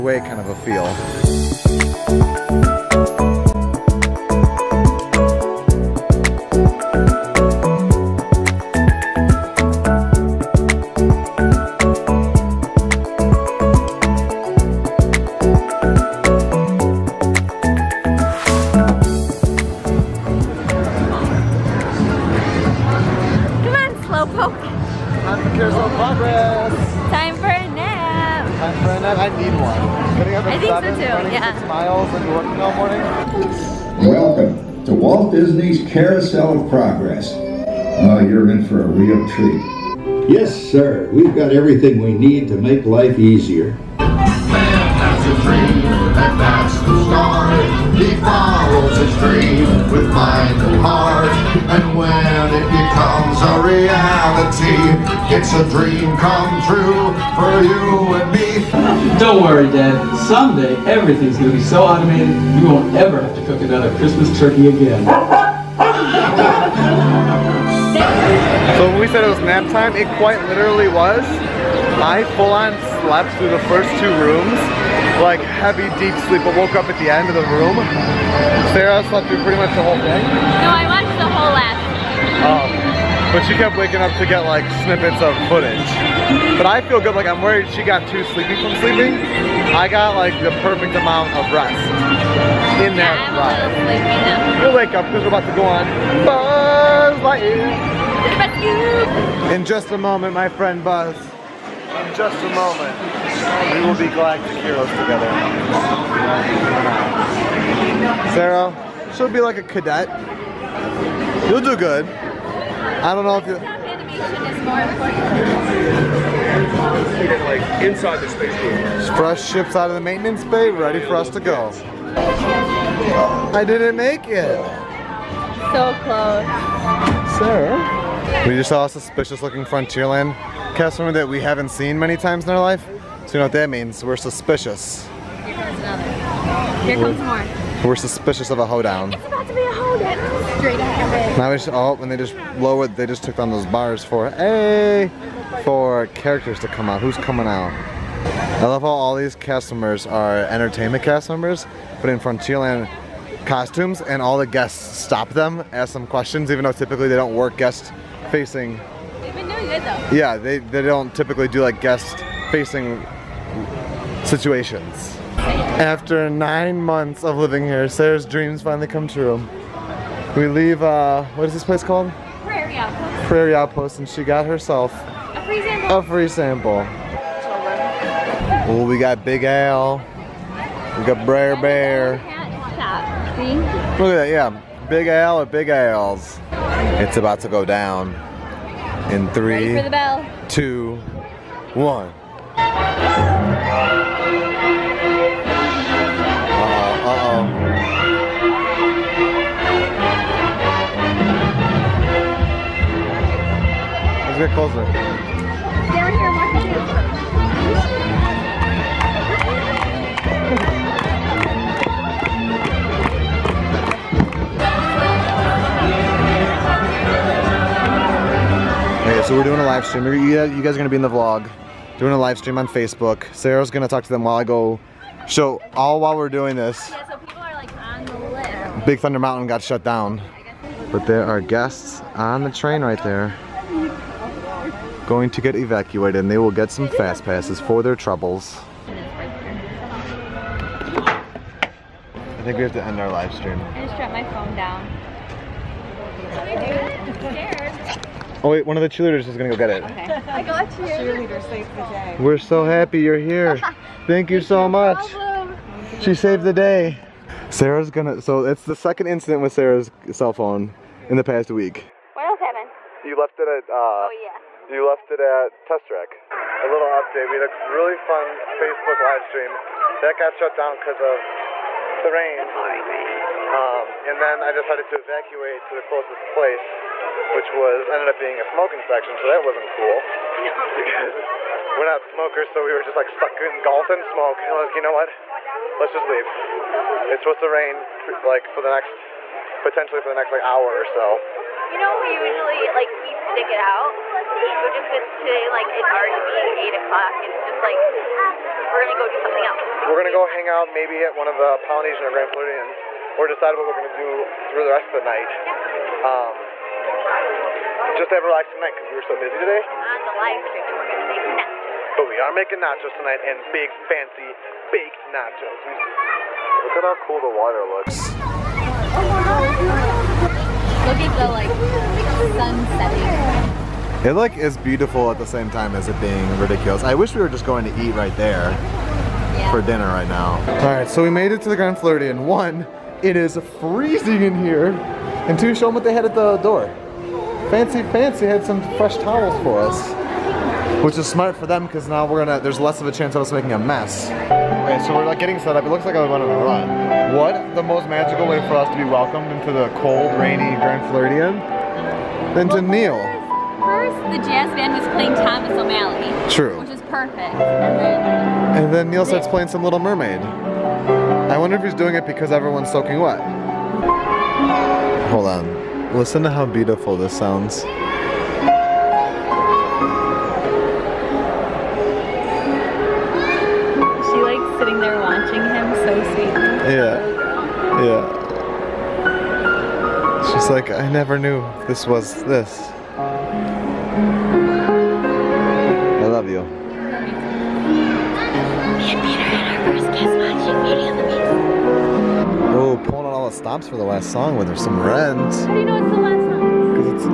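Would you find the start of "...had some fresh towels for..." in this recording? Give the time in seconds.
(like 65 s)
338 s.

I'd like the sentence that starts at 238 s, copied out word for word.
I think we have to end our live stream.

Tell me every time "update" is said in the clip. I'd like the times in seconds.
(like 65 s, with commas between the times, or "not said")
266 s.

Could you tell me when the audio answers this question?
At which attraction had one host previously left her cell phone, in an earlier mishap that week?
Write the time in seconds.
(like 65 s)
265 s.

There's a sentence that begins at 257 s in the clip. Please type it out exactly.
Sarah's gonna, so it's the second incident with Sarah's cell phone in the past week.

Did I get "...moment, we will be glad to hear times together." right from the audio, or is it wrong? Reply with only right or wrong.
wrong.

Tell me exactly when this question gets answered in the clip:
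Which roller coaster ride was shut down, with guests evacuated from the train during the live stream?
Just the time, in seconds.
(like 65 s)
228 s.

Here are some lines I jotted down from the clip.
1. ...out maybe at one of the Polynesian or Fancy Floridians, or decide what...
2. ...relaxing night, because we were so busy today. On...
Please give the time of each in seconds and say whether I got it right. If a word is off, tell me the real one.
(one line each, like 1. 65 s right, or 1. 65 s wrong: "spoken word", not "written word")
1. 300 s wrong: "Grand", not "Fancy"
2. 308 s right.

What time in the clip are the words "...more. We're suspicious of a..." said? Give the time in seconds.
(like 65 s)
137 s.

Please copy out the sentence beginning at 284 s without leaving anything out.
And I was like, you know what?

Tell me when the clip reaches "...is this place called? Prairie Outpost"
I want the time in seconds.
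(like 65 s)
171 s.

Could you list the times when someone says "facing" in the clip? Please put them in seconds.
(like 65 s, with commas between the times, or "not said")
158 s, 162 s.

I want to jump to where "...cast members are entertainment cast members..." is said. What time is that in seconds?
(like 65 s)
149 s.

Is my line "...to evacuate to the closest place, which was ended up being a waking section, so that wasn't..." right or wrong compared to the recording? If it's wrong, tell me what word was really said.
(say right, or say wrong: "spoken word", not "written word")
wrong: "smoking", not "waking".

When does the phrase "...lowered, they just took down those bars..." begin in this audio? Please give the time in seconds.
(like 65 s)
142 s.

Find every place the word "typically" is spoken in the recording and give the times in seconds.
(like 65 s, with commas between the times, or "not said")
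156 s, 161 s.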